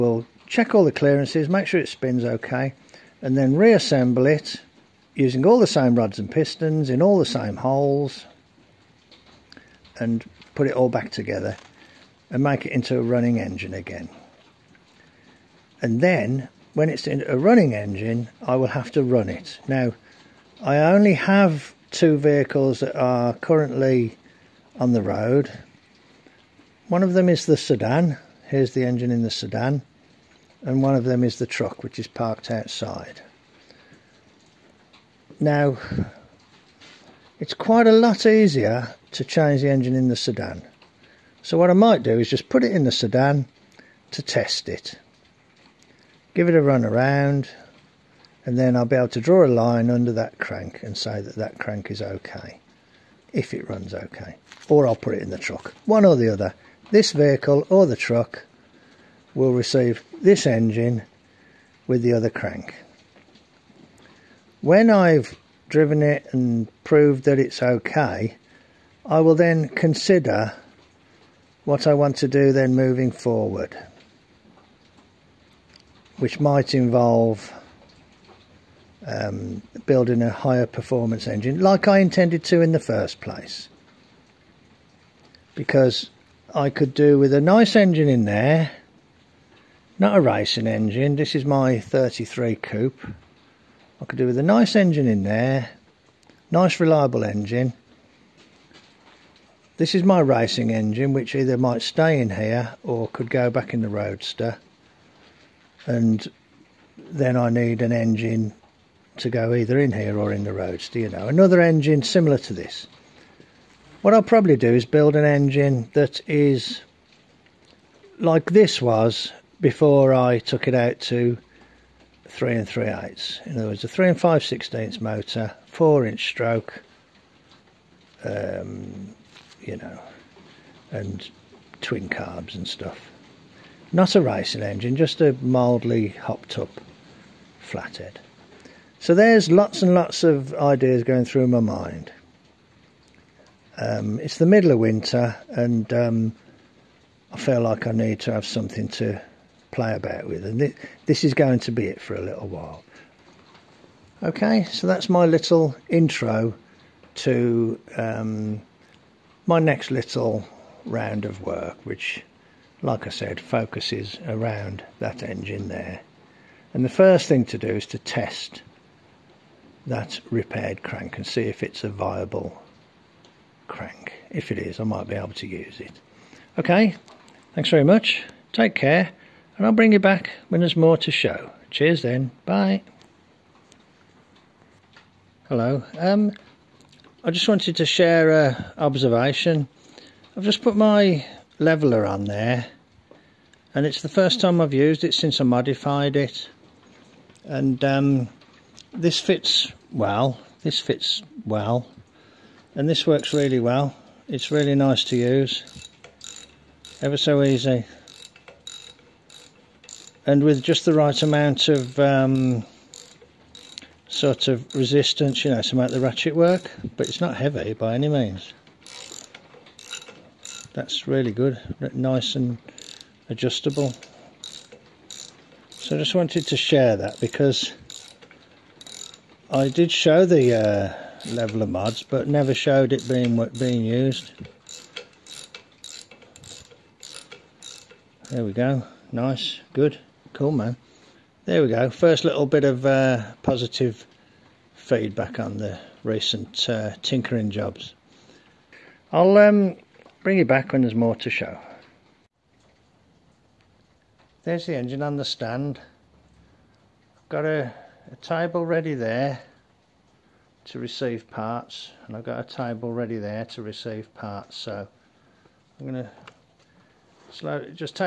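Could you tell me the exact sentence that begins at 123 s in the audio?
In other words, a 3 and 5 sixteenths motor, 4 inch stroke, um, you know, and twin carbs and stuff.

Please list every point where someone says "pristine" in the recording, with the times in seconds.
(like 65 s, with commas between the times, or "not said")
not said.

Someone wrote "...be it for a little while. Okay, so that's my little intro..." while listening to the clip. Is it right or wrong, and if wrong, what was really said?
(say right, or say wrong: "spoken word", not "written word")
right.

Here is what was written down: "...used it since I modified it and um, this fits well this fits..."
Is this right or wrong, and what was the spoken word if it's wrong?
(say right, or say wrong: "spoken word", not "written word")
right.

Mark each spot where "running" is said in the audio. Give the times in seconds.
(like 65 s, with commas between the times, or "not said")
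13 s, 17 s.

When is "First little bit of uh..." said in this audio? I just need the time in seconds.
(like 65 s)
241 s.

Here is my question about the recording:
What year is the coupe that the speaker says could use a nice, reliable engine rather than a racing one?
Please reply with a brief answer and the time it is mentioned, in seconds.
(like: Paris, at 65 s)
1933, at 91 s.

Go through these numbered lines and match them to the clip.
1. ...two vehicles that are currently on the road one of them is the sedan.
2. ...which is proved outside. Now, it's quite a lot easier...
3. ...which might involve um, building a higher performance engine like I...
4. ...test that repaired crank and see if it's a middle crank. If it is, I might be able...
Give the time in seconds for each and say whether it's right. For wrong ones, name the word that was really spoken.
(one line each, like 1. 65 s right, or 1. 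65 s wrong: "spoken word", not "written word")
1. 21 s right
2. 31 s wrong: "parked", not "proved"
3. 76 s right
4. 167 s wrong: "viable", not "middle".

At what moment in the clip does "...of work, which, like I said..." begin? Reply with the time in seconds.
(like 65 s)
161 s.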